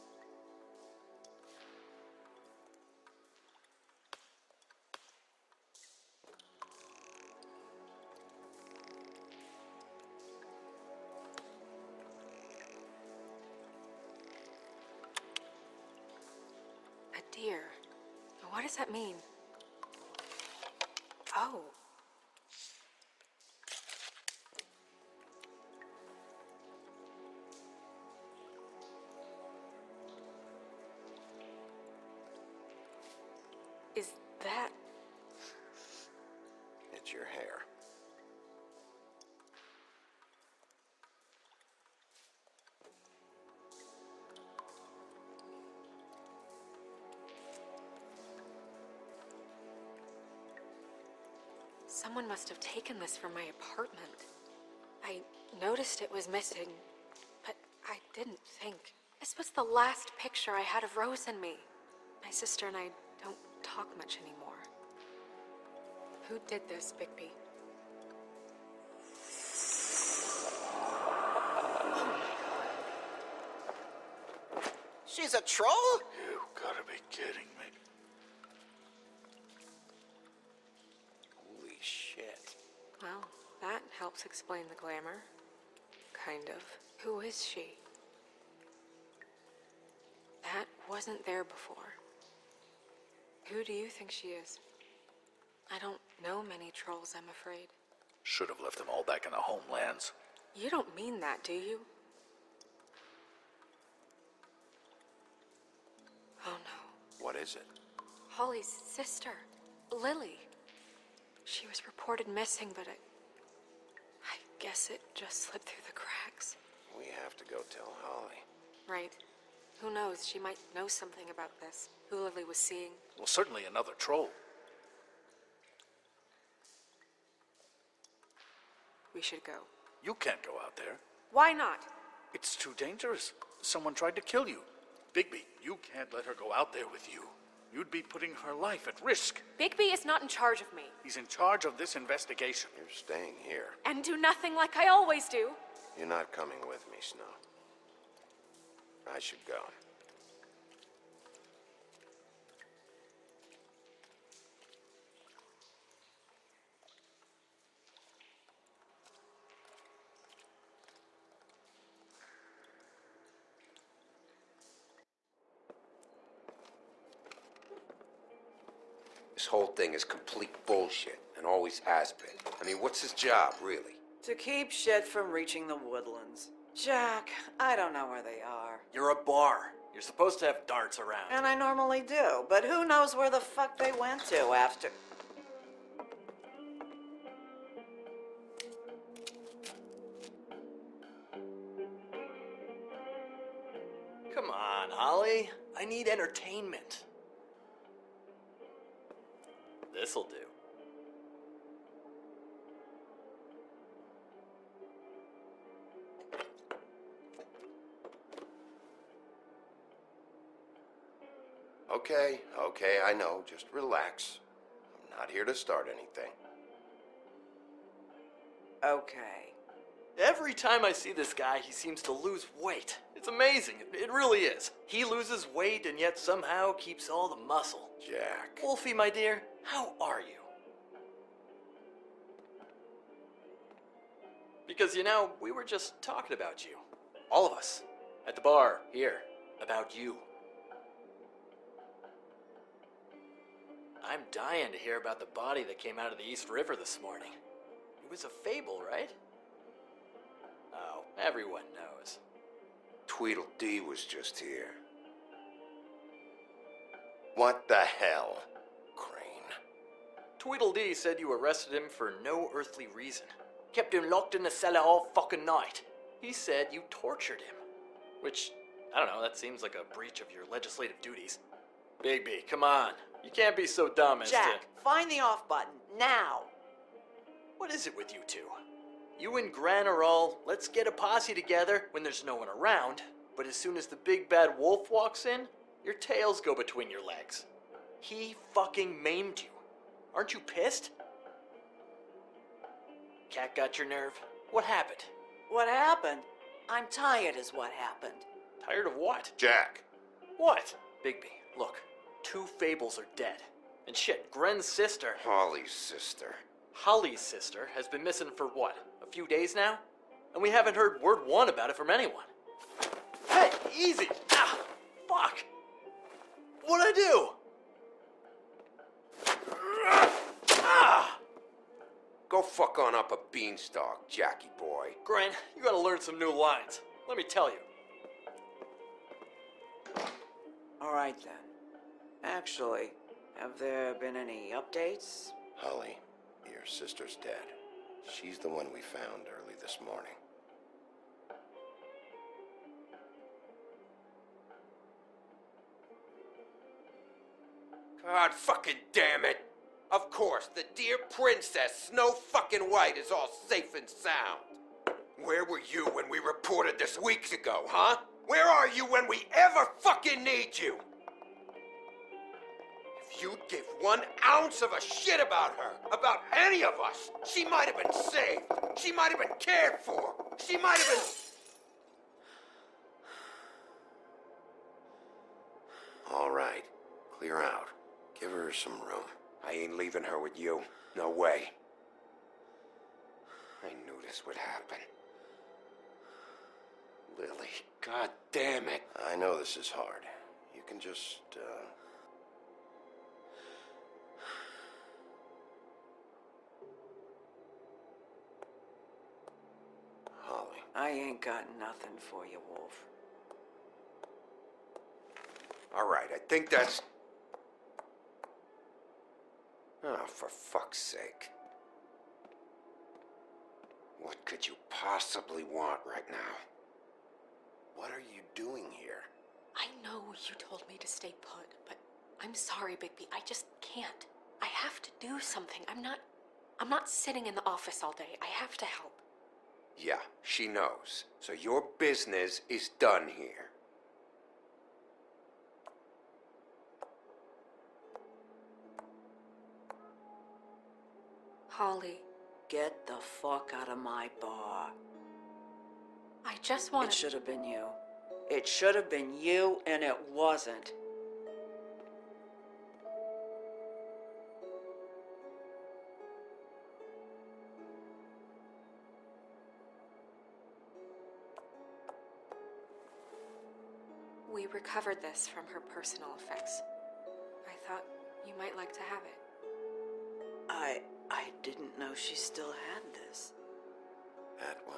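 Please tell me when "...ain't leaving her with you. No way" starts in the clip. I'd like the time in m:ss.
6:19.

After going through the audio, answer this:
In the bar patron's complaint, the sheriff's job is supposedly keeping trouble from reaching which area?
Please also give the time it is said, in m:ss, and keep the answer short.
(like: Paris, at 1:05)
The woodlands, at 2:55.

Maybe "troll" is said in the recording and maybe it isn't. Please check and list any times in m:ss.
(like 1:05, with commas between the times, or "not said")
1:15, 1:36, 2:03.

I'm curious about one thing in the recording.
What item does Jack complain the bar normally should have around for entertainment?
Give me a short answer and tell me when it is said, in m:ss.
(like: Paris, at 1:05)
Darts, at 3:00.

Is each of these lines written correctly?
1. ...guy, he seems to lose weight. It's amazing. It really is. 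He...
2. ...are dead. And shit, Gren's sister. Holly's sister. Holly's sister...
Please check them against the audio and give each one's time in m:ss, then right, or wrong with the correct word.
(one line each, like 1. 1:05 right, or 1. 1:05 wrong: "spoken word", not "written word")
1. 3:41 right
2. 5:02 right.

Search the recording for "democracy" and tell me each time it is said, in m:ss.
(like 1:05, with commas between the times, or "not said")
not said.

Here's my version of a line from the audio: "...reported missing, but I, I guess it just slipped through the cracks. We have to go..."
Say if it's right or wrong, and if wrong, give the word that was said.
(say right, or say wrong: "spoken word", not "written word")
right.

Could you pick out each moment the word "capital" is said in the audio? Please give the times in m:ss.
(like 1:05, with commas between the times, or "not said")
not said.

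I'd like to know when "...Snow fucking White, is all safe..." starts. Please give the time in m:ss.
5:51.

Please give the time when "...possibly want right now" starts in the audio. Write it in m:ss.
6:54.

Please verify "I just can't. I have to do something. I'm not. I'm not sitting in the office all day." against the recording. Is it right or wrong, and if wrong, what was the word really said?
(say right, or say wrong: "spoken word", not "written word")
right.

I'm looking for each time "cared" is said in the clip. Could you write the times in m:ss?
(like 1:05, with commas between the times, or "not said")
6:09.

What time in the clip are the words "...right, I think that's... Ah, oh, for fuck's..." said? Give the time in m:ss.
6:45.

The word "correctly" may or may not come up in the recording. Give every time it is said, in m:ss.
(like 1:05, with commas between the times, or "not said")
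not said.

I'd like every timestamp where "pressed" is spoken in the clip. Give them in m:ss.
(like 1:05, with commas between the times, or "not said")
not said.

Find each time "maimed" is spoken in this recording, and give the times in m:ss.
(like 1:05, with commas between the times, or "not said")
4:49.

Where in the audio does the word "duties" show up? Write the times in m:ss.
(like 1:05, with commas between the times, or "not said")
4:31.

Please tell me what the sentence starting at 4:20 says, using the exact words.
Tweedledee said you arrested him for no earthly reason.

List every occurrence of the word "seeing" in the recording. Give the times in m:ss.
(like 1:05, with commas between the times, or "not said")
2:02.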